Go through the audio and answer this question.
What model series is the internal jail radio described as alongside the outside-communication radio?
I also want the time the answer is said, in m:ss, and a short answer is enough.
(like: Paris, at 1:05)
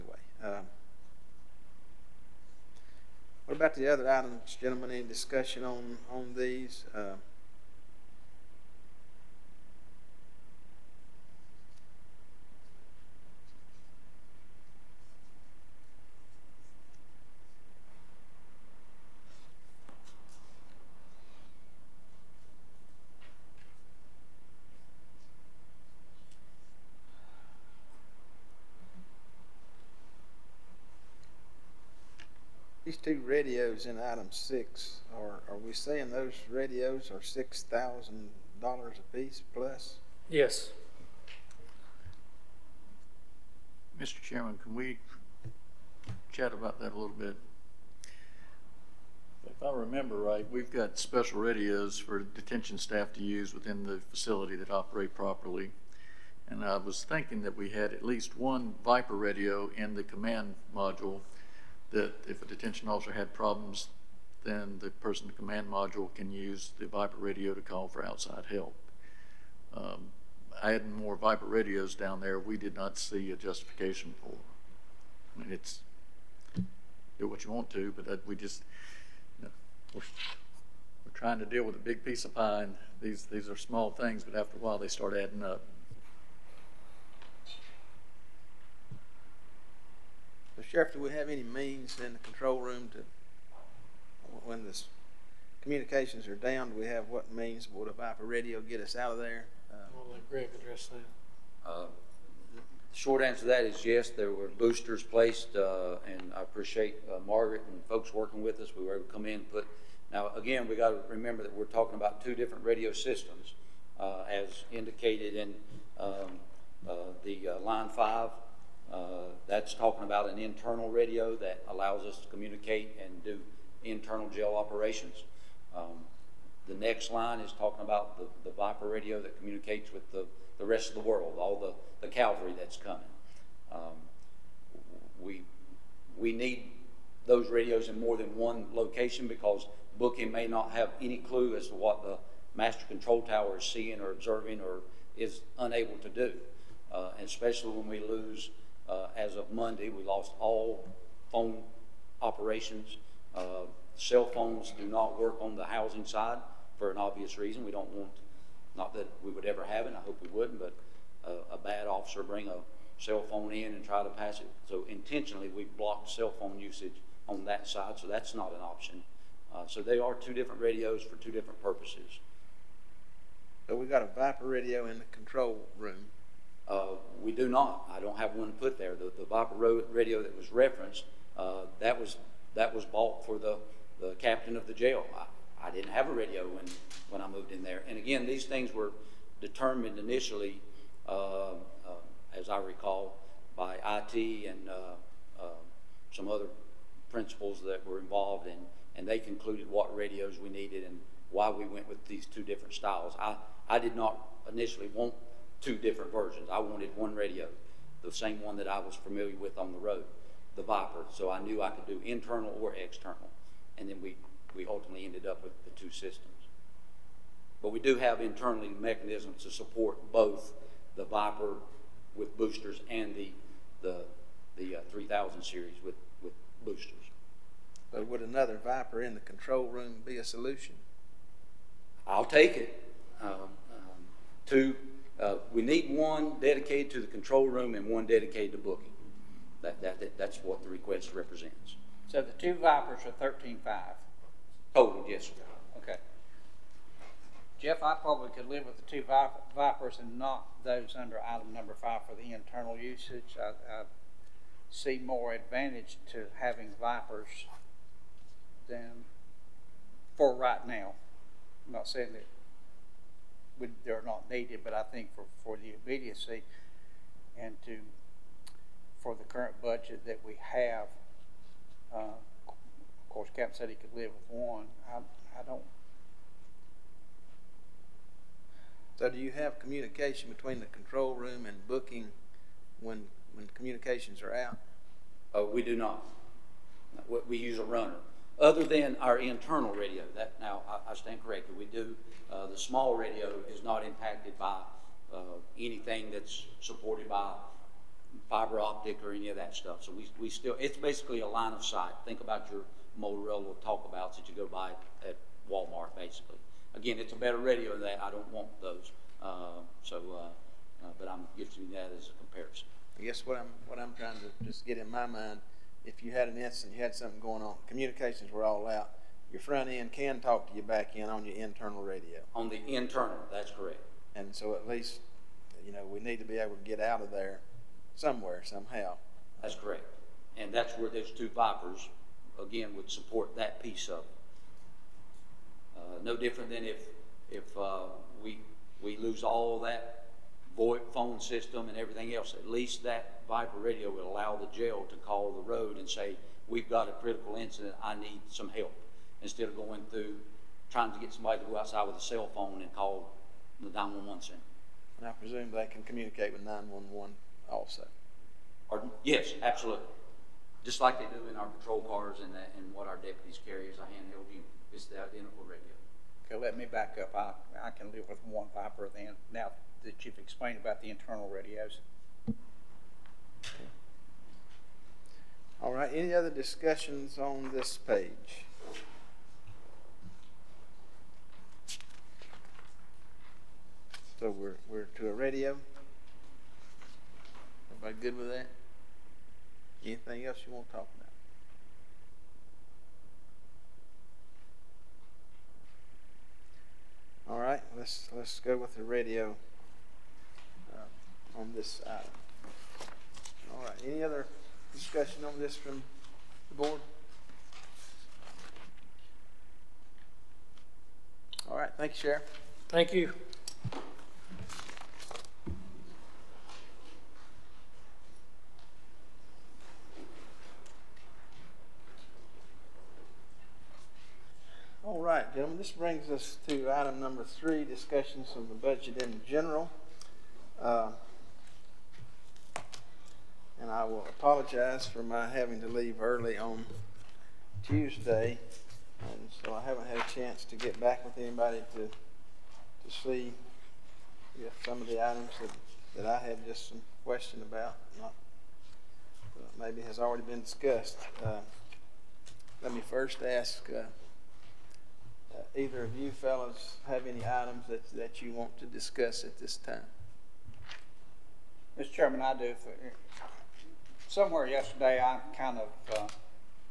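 3000 series, at 3:44.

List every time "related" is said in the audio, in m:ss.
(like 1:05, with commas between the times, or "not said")
not said.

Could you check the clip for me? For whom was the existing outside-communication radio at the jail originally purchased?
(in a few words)
The captain of the jail.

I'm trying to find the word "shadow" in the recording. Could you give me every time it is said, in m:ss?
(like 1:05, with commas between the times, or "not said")
not said.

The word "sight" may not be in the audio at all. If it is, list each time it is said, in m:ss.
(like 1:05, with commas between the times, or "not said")
5:01.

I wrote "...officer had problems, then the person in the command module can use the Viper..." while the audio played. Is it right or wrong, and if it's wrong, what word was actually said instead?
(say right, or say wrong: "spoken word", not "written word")
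right.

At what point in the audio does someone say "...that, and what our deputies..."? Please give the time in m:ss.
6:02.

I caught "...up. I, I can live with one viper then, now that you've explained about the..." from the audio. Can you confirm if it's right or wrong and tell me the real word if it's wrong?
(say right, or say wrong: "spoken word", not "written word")
right.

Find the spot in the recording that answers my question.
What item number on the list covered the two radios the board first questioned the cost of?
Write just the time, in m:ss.
0:34.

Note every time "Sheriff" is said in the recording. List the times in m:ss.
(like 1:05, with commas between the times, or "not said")
1:30, 6:51.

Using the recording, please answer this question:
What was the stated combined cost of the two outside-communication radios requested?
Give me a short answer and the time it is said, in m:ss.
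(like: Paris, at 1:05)
13,500, at 4:03.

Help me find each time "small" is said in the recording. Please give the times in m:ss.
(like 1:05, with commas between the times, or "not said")
1:23, 4:52.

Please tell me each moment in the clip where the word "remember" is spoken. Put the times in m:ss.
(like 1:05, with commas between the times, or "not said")
0:49, 1:51.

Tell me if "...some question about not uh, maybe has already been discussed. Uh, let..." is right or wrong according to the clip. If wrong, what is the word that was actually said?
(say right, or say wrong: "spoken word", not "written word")
right.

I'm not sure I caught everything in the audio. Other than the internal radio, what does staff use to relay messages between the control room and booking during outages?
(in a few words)
A runner.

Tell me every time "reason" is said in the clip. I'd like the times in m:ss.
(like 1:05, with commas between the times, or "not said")
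2:37.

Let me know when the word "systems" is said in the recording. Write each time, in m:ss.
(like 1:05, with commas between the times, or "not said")
1:52, 3:35, 5:41.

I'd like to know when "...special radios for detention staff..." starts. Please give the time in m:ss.
0:50.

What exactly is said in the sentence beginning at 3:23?
I, I did not initially want two different versions.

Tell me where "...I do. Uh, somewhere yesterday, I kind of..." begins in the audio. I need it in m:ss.
7:42.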